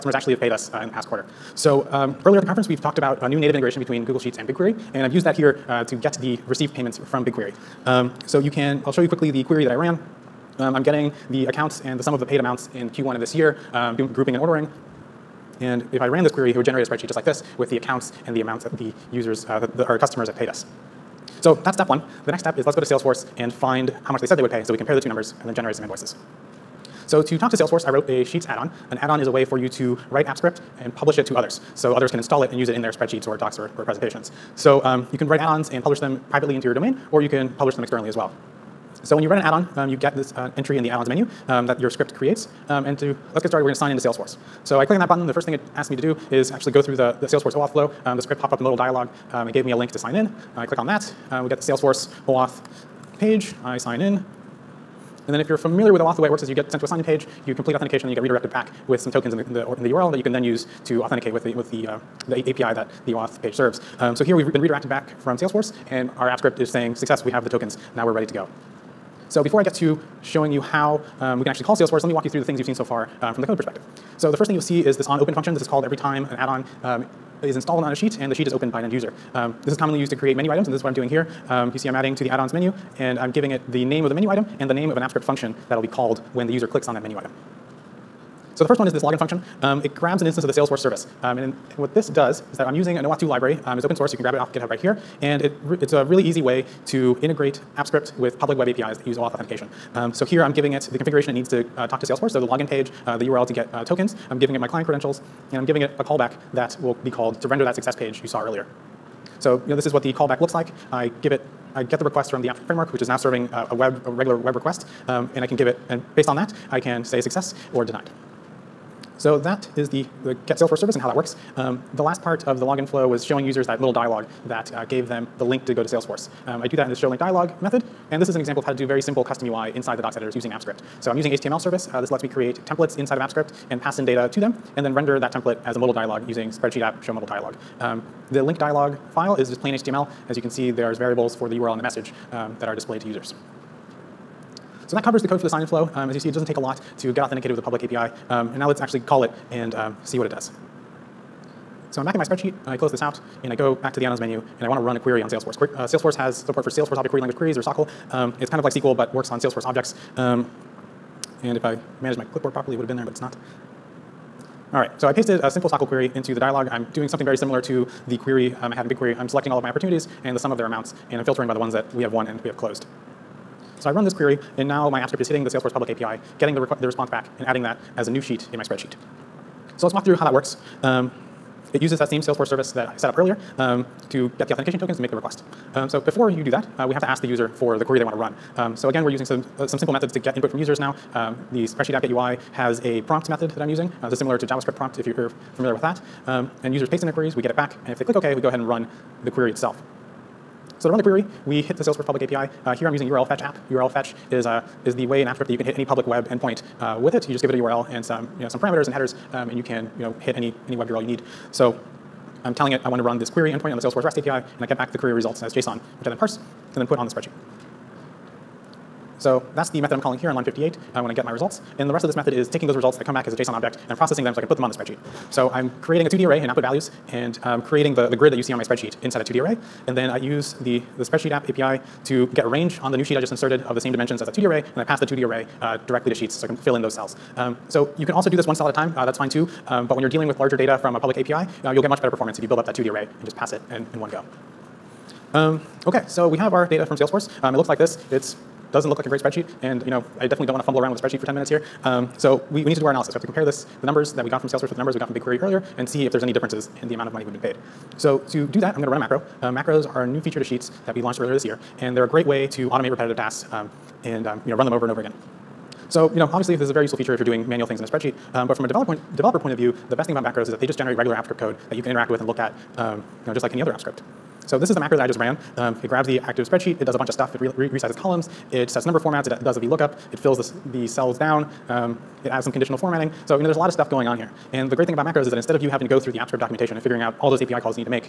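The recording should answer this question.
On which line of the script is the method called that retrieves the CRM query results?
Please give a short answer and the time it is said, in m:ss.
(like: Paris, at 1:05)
58, at 3:40.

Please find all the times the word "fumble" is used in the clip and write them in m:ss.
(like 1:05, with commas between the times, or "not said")
4:10.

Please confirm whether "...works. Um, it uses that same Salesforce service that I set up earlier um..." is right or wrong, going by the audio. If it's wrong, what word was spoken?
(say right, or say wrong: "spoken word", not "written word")
right.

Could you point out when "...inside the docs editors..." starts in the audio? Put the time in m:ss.
2:09.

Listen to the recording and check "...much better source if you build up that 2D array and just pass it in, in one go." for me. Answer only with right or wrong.
wrong.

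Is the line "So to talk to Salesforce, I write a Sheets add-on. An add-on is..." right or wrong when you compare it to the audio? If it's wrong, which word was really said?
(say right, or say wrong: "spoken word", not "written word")
wrong: "wrote", not "write".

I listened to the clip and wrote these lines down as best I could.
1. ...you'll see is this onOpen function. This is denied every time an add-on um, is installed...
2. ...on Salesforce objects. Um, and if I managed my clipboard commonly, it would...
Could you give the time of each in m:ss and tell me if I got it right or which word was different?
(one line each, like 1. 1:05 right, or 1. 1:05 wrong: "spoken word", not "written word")
1. 1:14 wrong: "called", not "denied"
2. 2:39 wrong: "properly", not "commonly".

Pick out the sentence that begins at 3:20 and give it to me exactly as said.
So to run the query, we hit the Salesforce public API.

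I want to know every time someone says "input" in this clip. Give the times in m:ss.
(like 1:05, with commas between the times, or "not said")
3:10.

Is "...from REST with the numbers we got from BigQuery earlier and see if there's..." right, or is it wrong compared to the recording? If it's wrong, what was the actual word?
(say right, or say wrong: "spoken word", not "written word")
wrong: "Salesforce", not "REST".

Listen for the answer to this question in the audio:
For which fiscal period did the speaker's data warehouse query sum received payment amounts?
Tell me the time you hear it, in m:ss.
0:12.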